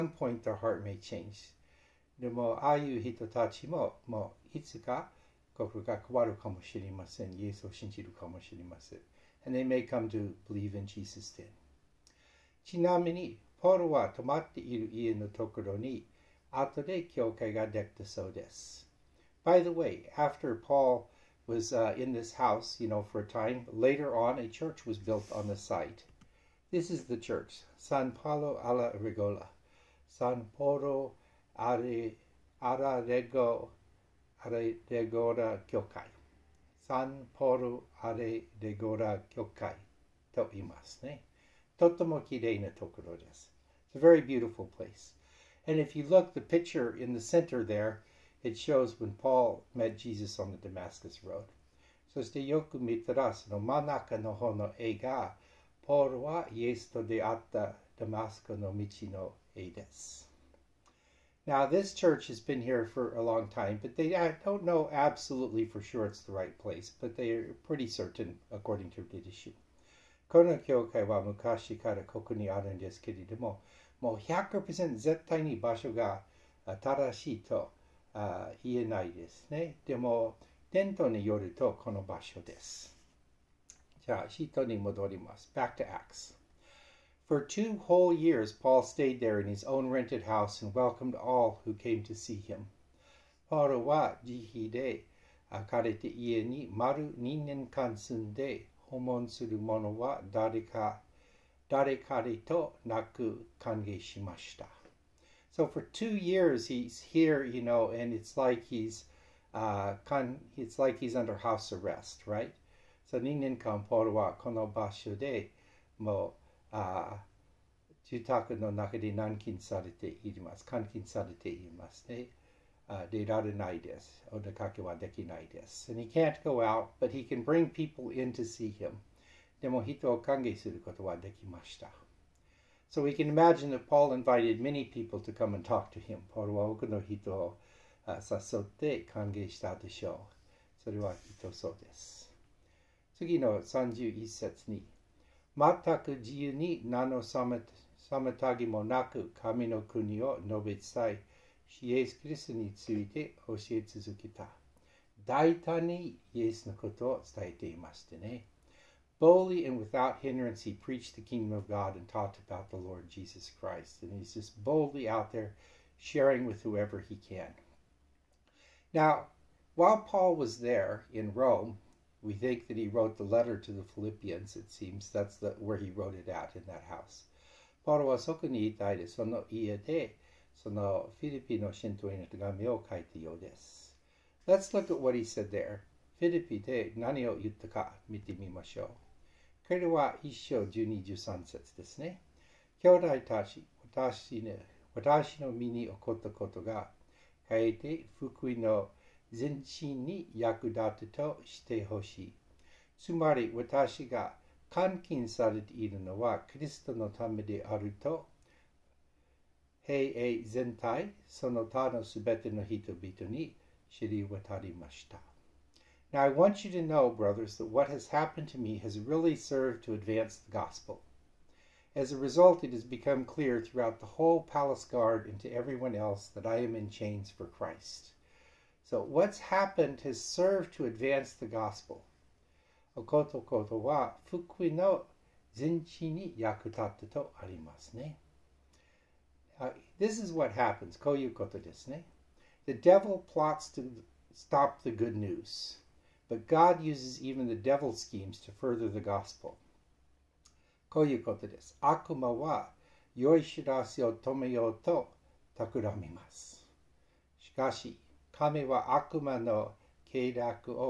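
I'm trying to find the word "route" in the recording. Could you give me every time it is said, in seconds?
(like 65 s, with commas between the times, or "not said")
not said.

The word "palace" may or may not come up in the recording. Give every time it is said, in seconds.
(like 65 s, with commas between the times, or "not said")
224 s.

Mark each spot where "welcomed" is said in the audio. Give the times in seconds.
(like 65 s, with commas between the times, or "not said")
90 s.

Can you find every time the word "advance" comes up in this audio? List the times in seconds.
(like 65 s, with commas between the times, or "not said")
219 s, 230 s.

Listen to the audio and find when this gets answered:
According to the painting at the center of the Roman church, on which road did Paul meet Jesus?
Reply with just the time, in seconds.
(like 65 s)
50 s.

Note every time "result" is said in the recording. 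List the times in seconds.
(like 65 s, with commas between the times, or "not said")
222 s.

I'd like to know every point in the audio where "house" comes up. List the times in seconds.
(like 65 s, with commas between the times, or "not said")
22 s, 90 s, 111 s, 176 s.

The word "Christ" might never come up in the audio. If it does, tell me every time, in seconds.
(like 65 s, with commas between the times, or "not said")
163 s, 227 s.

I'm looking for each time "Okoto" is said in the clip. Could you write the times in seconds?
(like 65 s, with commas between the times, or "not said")
232 s.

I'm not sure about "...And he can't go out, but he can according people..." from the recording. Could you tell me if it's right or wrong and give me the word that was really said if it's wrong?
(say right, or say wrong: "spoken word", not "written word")
wrong: "bring", not "according".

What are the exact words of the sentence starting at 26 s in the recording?
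This is the church, San Paolo alla Regola, San Poro Ararego Aredegora Kyokai, San Poro Aredegora Kyokai to imasu ne.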